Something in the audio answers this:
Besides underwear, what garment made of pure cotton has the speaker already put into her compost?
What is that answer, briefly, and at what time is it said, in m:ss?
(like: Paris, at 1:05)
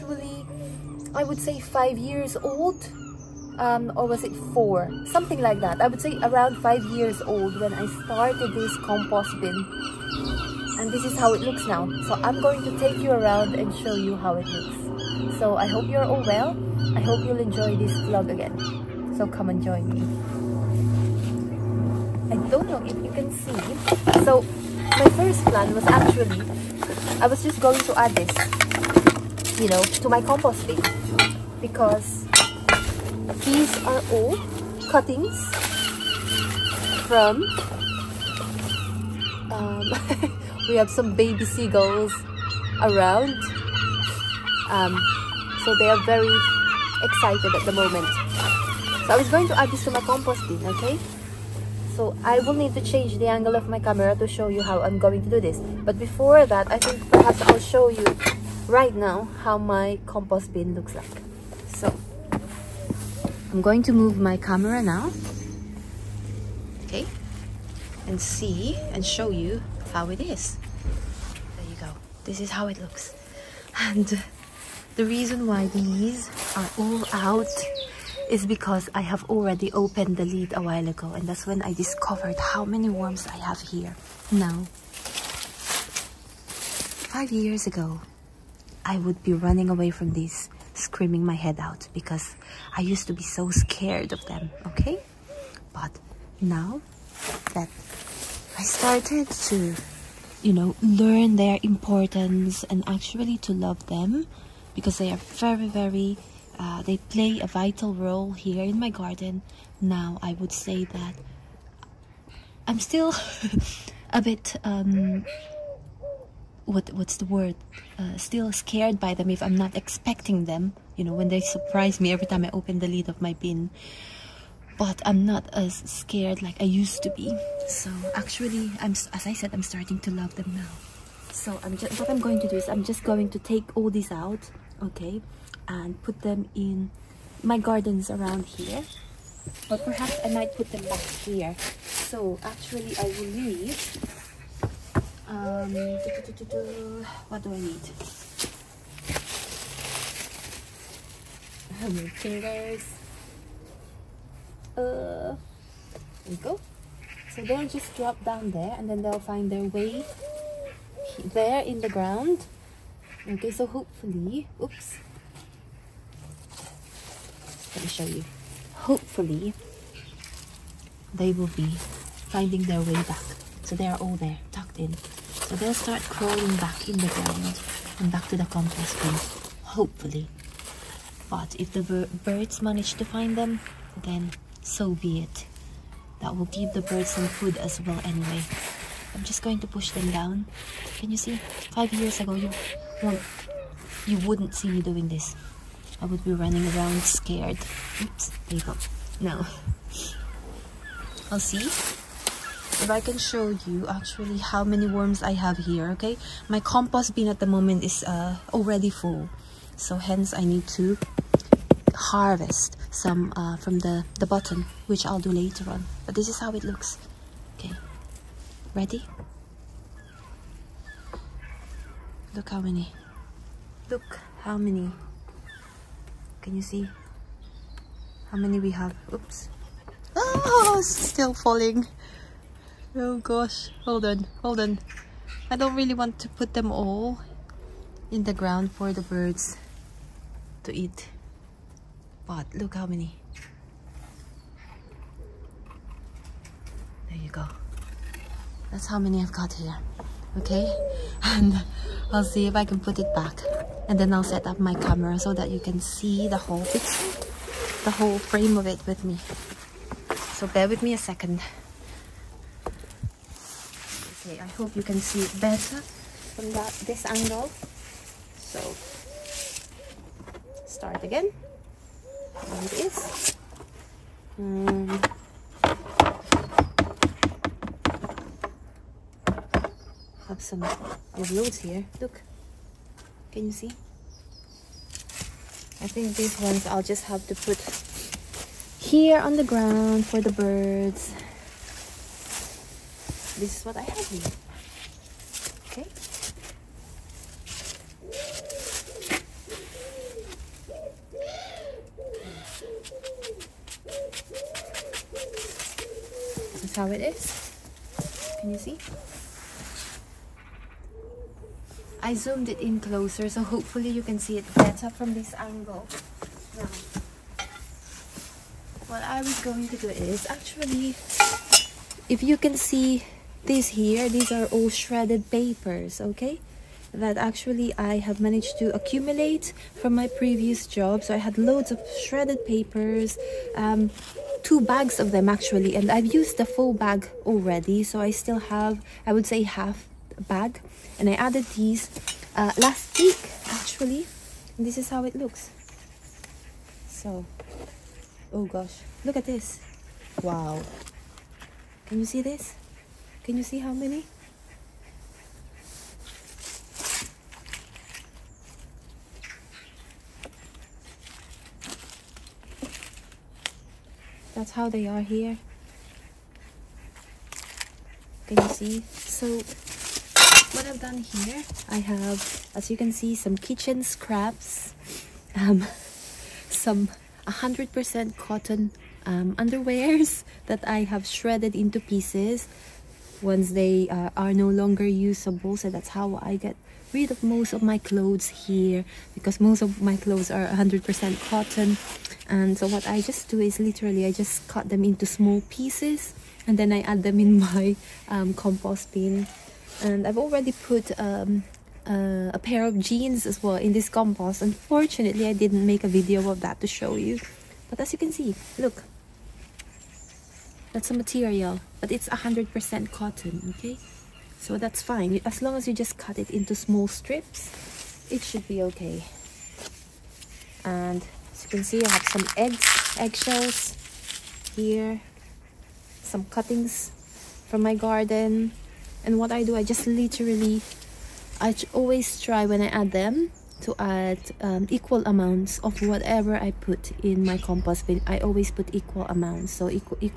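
A pair of jeans, at 6:42.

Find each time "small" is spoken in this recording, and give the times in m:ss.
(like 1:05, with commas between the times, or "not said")
6:35, 6:56.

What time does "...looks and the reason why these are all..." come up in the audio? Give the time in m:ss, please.
1:12.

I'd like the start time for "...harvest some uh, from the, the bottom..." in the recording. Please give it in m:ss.
3:31.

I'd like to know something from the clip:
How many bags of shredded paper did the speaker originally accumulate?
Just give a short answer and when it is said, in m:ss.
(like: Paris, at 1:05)
2, at 5:34.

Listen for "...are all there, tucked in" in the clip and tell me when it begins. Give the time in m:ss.
2:53.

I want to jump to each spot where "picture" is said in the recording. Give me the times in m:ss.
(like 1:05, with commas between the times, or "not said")
4:16.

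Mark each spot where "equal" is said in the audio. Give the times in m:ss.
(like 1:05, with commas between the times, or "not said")
7:14, 7:18.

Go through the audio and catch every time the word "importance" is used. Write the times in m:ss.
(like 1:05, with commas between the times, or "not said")
1:41.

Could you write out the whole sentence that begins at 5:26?
That actually I have managed to accumulate from my previous job.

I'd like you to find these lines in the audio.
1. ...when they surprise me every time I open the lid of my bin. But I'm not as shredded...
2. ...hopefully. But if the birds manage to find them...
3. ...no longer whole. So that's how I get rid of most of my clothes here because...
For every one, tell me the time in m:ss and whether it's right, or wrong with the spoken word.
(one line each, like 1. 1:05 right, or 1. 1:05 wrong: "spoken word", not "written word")
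1. 2:01 wrong: "scared", not "shredded"
2. 2:59 right
3. 6:24 wrong: "usable", not "whole".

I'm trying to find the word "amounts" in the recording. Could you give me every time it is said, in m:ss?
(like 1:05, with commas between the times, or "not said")
7:15, 7:19.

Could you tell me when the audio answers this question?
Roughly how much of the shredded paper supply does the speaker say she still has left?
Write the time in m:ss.
5:39.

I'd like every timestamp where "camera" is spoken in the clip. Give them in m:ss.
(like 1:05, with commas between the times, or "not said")
0:53, 1:04, 4:14.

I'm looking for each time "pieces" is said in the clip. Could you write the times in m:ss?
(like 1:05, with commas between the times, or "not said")
6:21, 6:35.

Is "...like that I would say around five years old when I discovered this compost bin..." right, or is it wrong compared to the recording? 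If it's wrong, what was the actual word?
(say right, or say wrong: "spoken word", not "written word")
wrong: "started", not "discovered".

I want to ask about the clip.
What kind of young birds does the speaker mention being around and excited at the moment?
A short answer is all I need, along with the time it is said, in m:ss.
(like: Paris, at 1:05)
Baby seagulls, at 0:41.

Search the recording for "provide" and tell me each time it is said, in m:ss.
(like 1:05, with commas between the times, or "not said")
not said.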